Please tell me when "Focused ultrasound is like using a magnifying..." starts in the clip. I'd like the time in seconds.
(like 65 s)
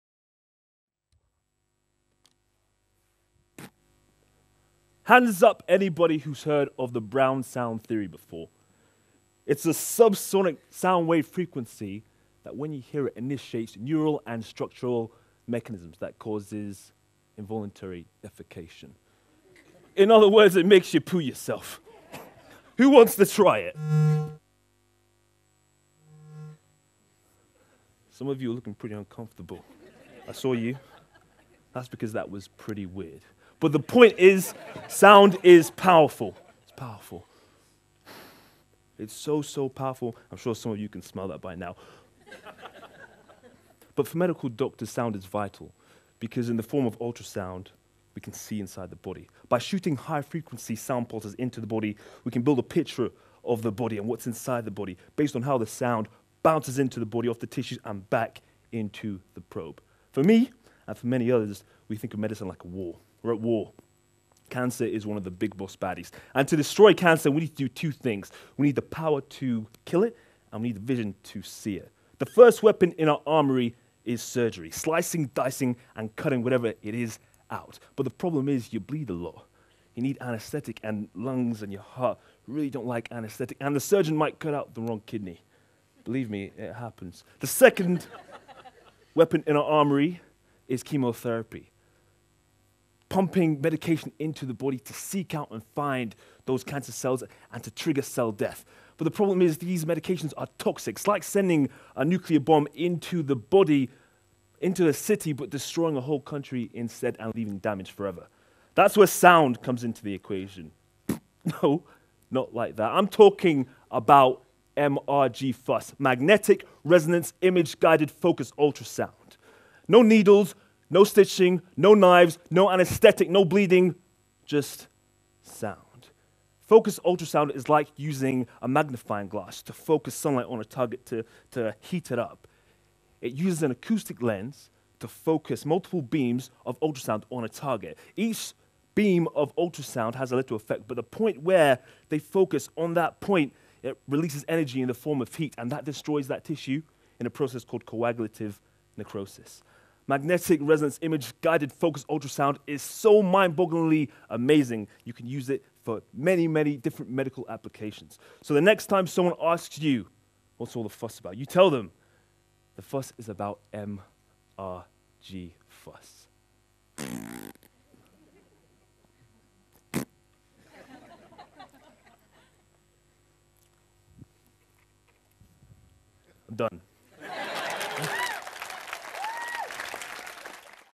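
126 s.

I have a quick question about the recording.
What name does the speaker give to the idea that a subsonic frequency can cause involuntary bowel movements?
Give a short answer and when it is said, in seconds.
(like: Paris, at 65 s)
Brown sound theory, at 7 s.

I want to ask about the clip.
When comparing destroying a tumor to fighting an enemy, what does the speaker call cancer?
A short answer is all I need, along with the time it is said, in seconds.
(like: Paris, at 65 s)
boss baddies, at 65 s.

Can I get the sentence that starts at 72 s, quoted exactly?
The first weapon in our armory is surgery, slicing, dicing, and cutting whatever it is out.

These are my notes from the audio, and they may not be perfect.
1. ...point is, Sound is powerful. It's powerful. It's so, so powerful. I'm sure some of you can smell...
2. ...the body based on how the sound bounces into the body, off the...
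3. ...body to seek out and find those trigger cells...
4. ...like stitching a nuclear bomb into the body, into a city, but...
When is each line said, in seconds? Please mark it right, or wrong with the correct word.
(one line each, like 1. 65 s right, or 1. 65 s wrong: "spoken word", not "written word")
1. 33 s right
2. 54 s right
3. 94 s wrong: "cancer", not "trigger"
4. 101 s wrong: "sending", not "stitching".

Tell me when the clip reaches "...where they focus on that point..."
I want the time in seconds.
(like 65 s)
141 s.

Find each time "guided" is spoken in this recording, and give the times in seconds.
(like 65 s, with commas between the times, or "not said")
117 s, 151 s.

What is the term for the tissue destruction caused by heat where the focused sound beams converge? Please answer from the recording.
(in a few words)
coagulative necrosis.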